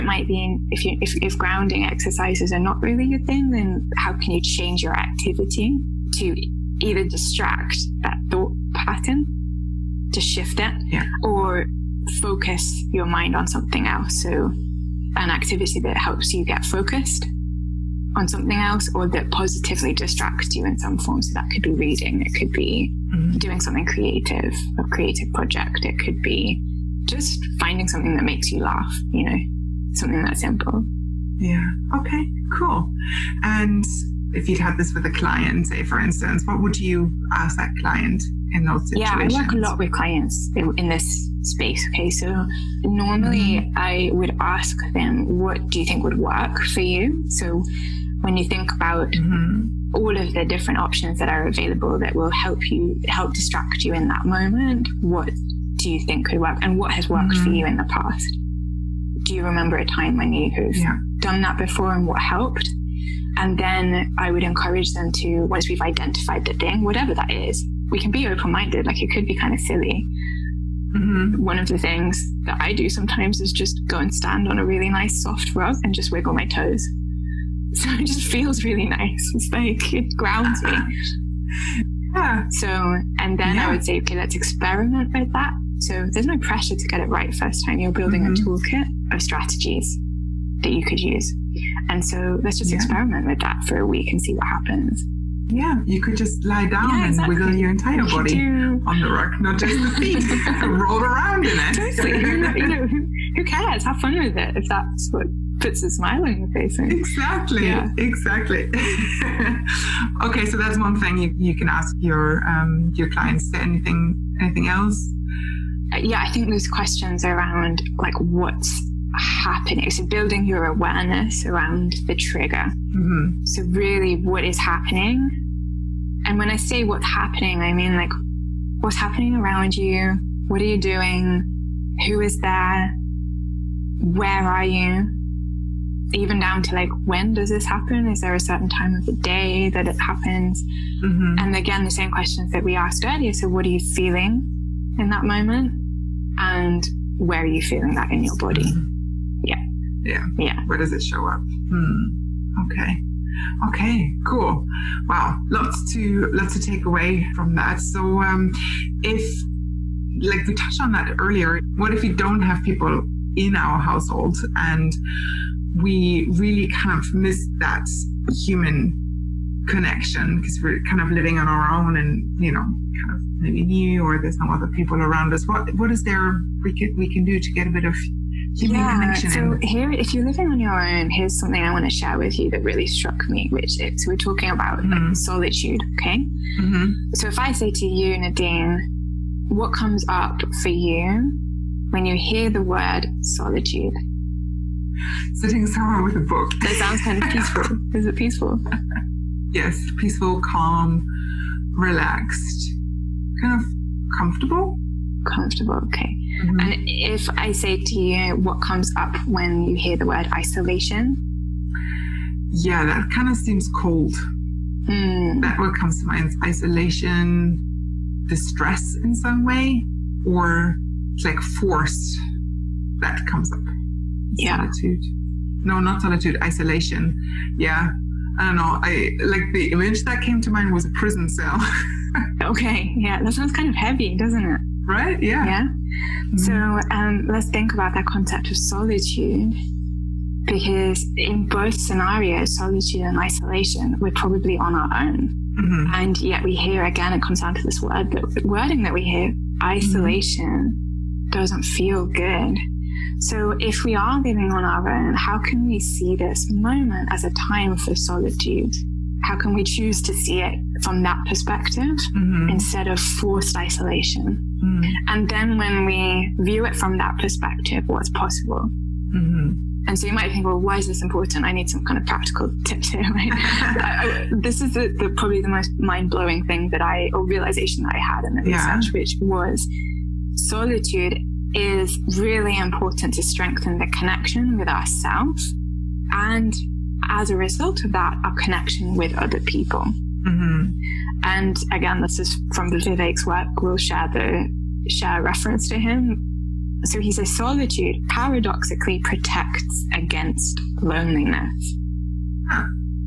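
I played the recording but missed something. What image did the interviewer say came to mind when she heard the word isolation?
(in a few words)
a prison cell.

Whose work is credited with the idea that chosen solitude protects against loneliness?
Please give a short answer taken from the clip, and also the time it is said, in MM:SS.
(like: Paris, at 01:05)
Vivek, at 04:52.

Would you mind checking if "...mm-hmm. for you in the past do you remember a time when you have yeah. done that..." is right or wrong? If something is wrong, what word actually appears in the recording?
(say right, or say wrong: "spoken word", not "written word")
right.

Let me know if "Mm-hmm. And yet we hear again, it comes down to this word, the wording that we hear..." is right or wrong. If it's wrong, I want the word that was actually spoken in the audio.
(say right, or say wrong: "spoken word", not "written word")
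right.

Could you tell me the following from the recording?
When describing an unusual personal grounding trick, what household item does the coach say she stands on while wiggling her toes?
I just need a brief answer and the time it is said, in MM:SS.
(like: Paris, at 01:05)
soft rug, at 01:14.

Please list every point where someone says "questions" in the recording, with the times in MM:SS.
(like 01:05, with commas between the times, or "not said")
01:56, 02:22.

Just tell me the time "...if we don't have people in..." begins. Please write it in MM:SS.
02:41.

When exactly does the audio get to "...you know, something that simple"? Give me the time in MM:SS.
00:29.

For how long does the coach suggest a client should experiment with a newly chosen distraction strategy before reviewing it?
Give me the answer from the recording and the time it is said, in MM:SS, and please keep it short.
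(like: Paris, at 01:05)
a week, at 01:33.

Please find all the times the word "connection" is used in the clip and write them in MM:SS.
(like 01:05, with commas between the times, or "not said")
02:49, 02:58, 04:43, 04:48.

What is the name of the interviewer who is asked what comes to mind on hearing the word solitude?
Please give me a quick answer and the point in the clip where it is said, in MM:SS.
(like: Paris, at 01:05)
Nadine, at 03:08.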